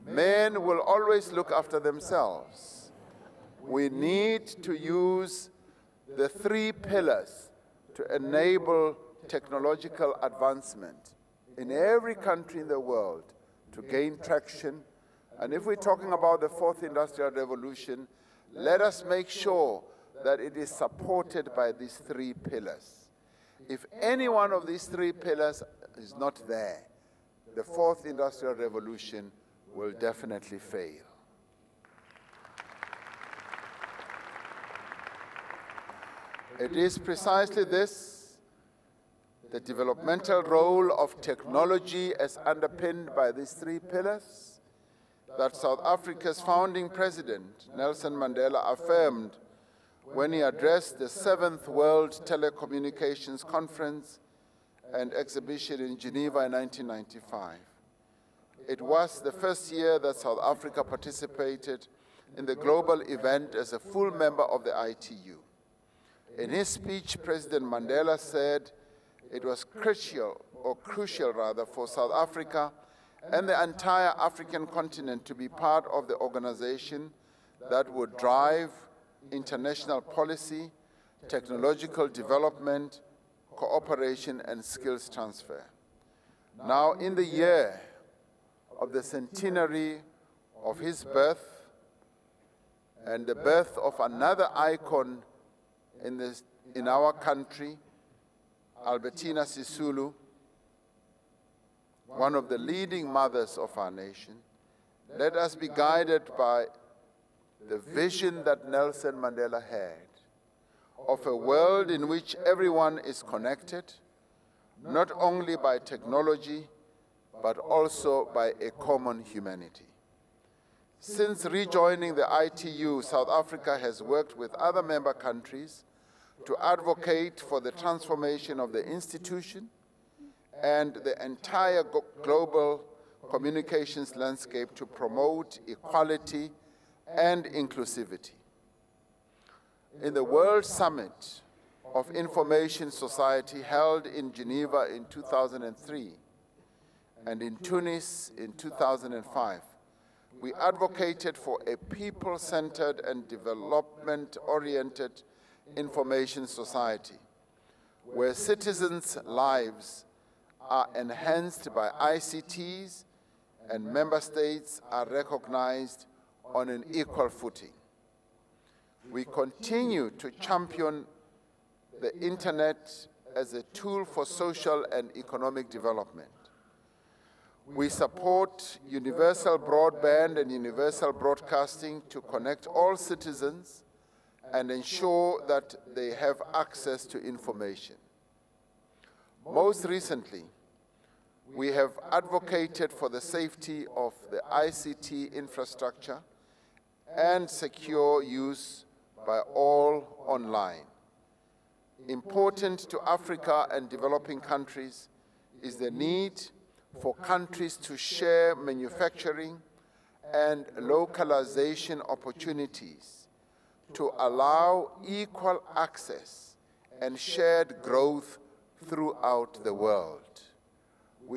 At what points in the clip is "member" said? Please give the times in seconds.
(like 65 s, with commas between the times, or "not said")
64 s, 124 s, 163 s.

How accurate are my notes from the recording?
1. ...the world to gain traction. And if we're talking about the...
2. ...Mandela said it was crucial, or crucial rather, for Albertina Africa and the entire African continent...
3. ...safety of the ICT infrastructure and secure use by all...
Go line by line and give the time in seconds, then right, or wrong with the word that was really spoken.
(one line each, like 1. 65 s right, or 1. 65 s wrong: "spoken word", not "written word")
1. 12 s right
2. 67 s wrong: "South", not "Albertina"
3. 193 s right.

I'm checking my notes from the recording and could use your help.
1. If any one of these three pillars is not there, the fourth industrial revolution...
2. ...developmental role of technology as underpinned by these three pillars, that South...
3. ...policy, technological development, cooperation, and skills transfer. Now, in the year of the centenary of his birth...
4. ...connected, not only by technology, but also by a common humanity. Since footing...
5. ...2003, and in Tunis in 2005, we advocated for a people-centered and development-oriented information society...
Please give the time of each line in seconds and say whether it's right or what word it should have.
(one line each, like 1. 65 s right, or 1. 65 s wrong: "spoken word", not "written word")
1. 23 s right
2. 39 s right
3. 79 s right
4. 113 s wrong: "rejoining", not "footing"
5. 145 s right.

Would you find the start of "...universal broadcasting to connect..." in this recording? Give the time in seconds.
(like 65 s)
180 s.